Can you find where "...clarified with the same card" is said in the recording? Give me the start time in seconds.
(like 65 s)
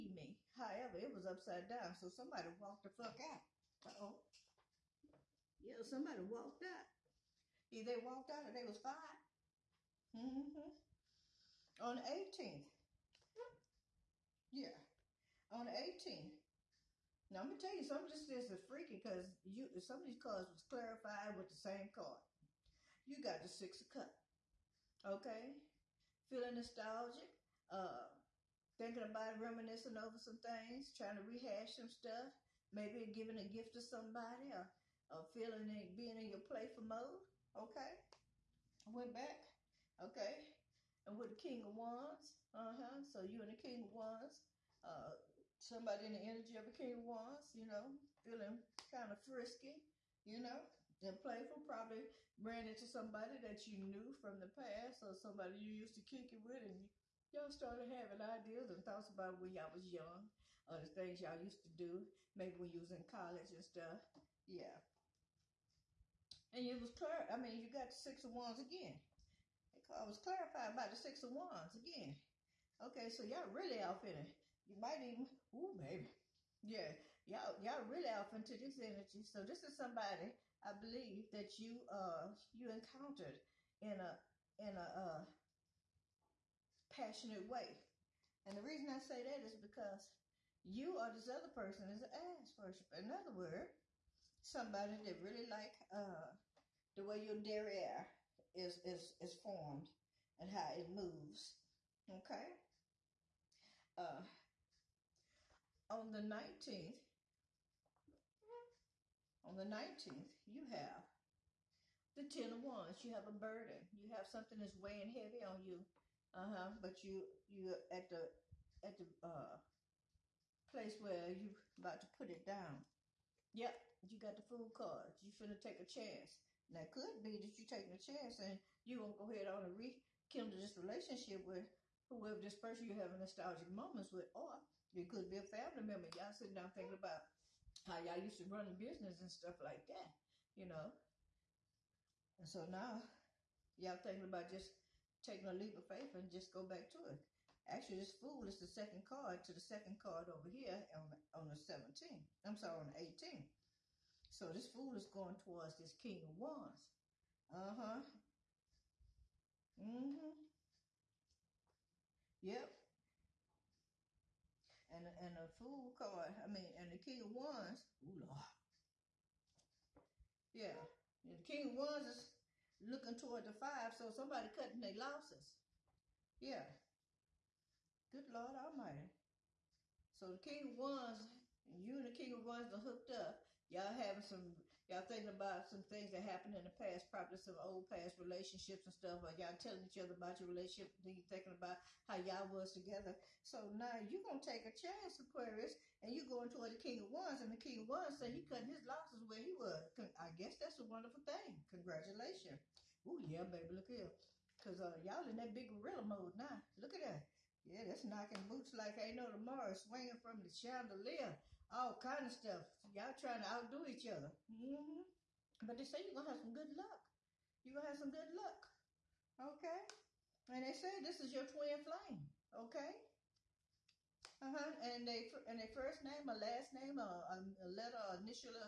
20 s.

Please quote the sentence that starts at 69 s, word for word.
I was clarified about the six of wands again.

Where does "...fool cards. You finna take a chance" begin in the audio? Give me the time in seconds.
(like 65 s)
124 s.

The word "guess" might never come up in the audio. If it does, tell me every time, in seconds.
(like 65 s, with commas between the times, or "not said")
200 s.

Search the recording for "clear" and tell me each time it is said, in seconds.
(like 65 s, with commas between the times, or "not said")
66 s.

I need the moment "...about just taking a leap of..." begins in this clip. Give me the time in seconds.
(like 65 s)
144 s.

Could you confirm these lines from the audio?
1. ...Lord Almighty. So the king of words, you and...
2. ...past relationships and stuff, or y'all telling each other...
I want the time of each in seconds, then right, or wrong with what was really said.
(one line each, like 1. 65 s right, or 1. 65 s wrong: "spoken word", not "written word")
1. 178 s wrong: "wands", not "words"
2. 187 s right.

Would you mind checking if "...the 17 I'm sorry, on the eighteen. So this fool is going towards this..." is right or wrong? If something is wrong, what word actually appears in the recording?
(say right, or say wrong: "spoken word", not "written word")
right.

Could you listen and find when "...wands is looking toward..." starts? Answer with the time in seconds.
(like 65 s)
171 s.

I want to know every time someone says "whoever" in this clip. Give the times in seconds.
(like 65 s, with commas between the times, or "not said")
132 s.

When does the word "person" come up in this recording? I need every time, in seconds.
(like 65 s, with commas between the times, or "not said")
91 s, 132 s.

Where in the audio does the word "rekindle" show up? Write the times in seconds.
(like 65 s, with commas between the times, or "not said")
129 s.